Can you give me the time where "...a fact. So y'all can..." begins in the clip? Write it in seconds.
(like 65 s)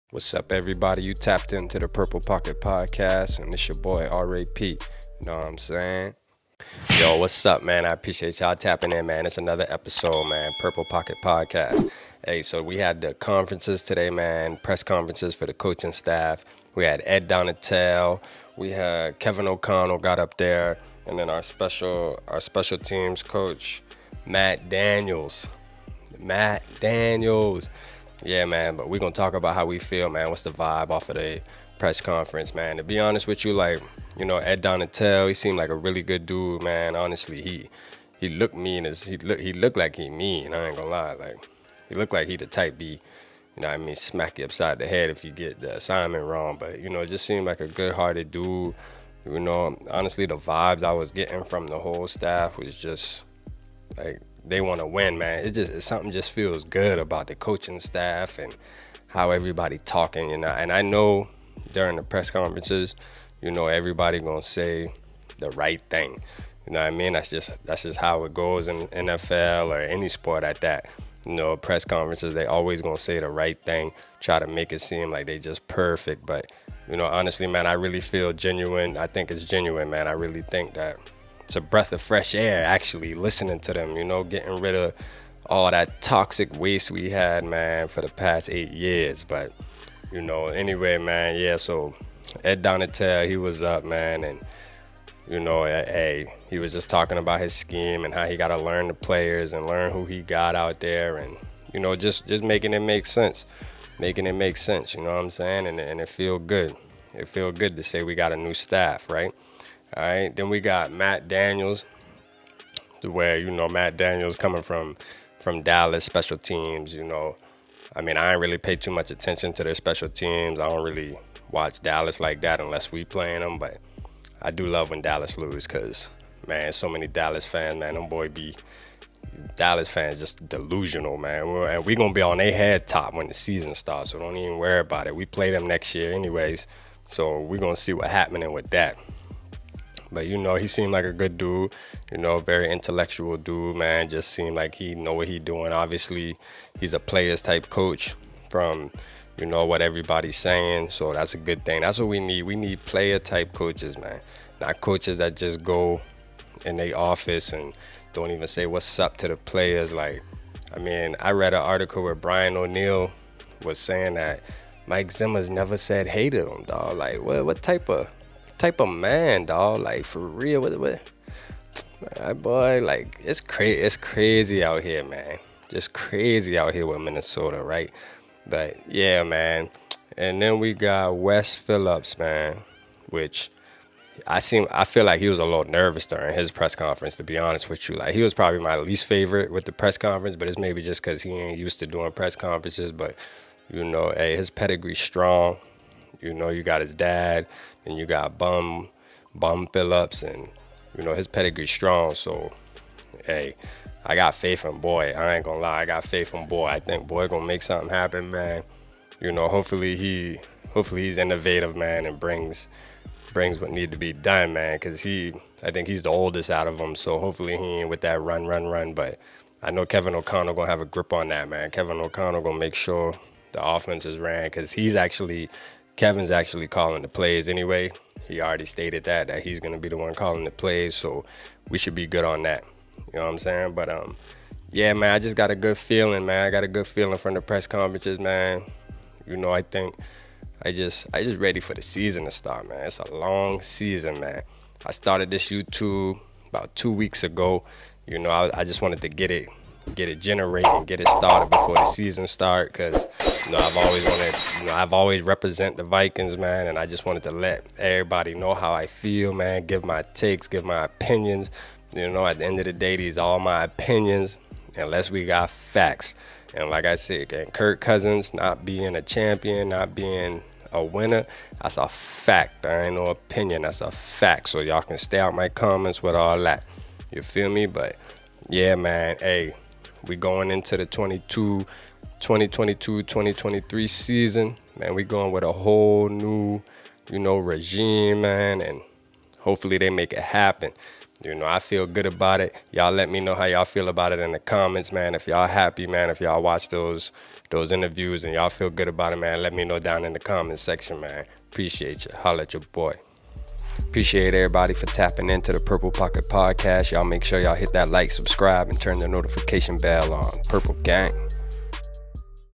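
273 s.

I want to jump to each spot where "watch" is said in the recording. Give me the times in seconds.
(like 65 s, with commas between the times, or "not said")
121 s, 296 s.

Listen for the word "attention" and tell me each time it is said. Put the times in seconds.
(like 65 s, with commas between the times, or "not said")
119 s.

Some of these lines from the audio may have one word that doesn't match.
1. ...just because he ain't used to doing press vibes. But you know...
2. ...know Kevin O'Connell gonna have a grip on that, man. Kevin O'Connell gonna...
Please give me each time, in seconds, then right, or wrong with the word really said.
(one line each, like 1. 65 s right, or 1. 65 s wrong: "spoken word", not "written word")
1. 190 s wrong: "conferences", not "vibes"
2. 219 s right.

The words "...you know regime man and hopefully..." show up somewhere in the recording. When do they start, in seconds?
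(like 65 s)
287 s.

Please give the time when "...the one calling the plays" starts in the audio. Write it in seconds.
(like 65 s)
229 s.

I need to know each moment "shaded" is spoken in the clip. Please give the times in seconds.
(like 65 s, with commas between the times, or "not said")
not said.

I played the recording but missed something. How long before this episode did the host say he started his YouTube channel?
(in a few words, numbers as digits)
2 weeks.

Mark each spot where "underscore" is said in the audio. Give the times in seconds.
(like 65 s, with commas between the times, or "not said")
not said.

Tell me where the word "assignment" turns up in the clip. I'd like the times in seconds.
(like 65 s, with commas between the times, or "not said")
45 s.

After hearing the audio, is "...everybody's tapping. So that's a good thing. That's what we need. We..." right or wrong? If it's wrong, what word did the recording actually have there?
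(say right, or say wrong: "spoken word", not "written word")
wrong: "saying", not "tapping".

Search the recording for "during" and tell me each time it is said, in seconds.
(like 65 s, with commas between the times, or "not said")
61 s, 186 s.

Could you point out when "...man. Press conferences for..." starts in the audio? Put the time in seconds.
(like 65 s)
14 s.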